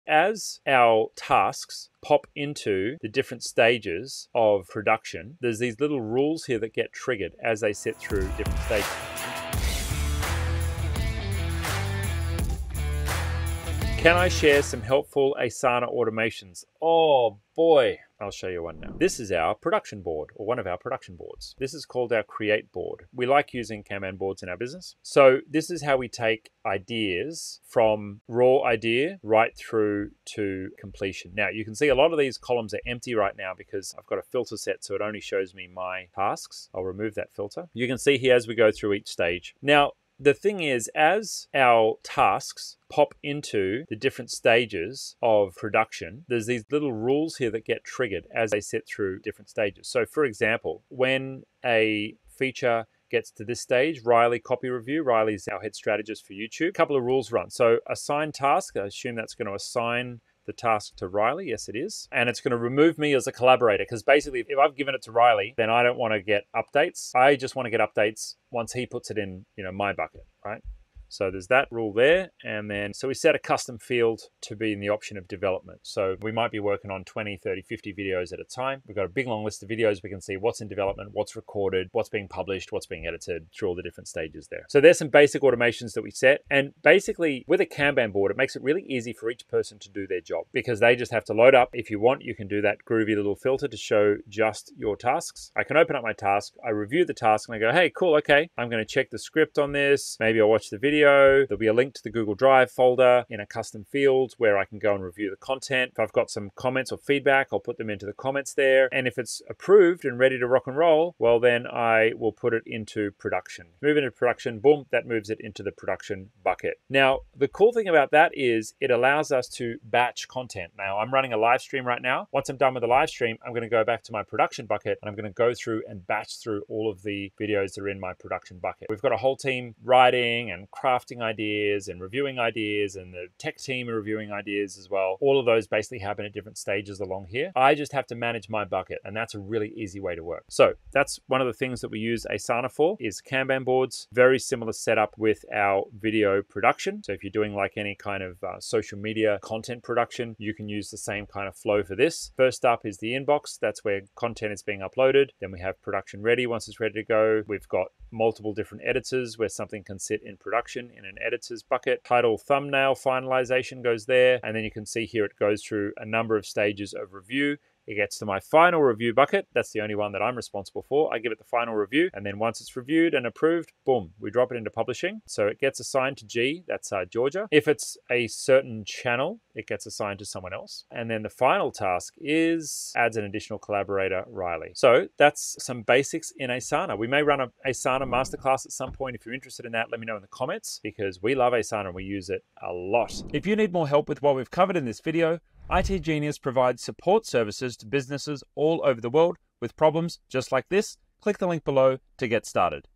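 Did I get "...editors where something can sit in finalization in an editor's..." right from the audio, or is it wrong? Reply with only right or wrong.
wrong.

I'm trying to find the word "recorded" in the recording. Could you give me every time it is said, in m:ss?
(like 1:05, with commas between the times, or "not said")
1:21.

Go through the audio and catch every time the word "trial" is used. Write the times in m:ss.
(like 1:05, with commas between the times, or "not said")
not said.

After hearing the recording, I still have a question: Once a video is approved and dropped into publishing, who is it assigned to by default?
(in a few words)
Georgia.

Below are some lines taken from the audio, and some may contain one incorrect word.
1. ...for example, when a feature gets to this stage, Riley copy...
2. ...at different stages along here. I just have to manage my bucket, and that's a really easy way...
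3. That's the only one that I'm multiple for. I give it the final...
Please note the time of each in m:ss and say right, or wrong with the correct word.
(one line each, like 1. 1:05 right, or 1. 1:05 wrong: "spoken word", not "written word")
1. 0:50 right
2. 2:16 right
3. 2:49 wrong: "responsible", not "multiple".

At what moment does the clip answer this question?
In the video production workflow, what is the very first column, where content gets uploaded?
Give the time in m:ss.
2:32.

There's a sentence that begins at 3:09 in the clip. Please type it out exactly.
If you're interested in that, let me know in the comments because we love Asana and we use it a lot.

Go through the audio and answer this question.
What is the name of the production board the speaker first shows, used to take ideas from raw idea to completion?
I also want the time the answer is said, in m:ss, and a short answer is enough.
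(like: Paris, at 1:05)
Create board, at 0:22.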